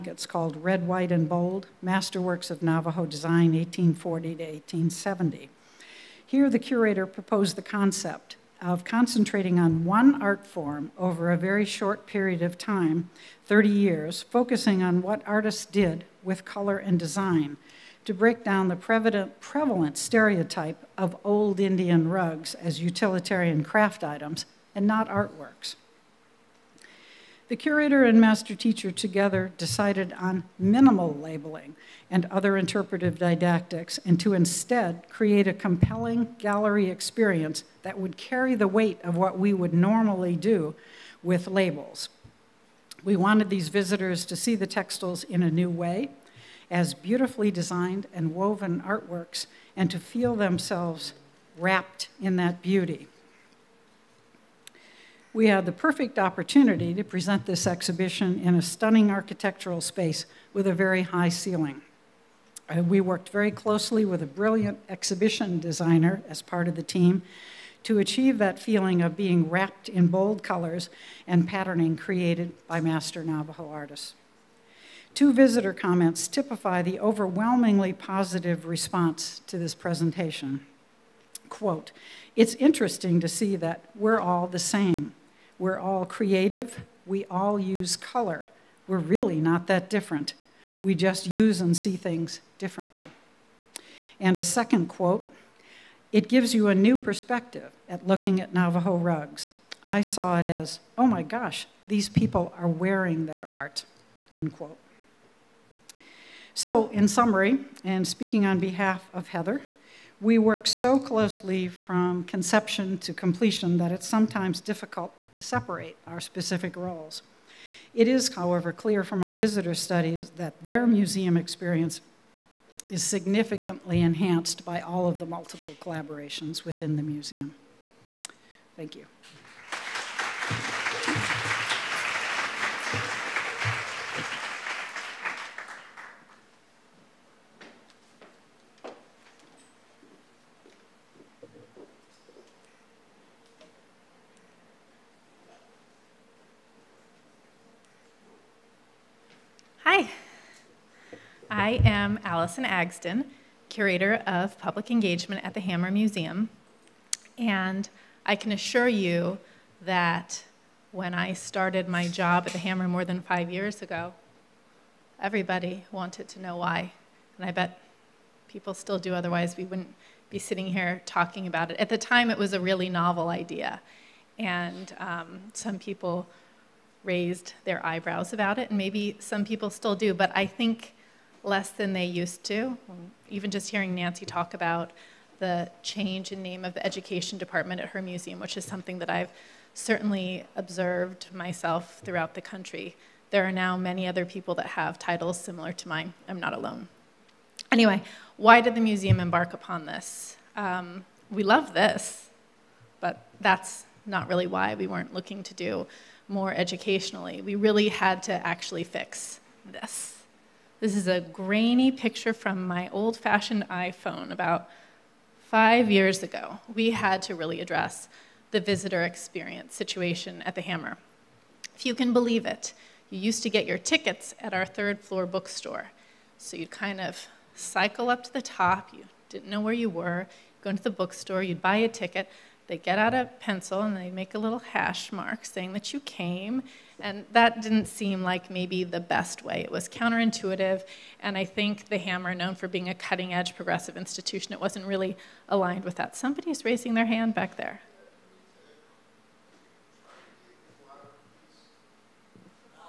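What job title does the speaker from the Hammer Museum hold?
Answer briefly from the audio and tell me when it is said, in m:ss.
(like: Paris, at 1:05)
Curator of Public Engagement, at 2:33.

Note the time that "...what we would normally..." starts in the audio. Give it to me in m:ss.
0:39.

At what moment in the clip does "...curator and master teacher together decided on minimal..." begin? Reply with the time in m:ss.
0:27.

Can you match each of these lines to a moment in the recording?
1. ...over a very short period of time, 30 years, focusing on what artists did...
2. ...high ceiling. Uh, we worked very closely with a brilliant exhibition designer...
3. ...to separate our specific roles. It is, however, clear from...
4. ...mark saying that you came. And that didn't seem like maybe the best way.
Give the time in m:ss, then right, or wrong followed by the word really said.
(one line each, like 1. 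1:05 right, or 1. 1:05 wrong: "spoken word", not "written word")
1. 0:10 right
2. 1:01 right
3. 1:55 right
4. 3:55 right.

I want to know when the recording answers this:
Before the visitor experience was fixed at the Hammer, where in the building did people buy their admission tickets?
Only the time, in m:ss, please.
3:44.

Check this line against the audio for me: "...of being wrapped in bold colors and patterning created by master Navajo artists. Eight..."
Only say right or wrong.
wrong.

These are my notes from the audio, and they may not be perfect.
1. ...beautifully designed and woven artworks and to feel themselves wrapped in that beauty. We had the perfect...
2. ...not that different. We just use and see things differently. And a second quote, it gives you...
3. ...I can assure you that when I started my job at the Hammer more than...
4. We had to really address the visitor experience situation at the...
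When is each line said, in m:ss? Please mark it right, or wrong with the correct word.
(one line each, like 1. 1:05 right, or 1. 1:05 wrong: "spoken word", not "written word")
1. 0:46 right
2. 1:29 right
3. 2:38 right
4. 3:36 right.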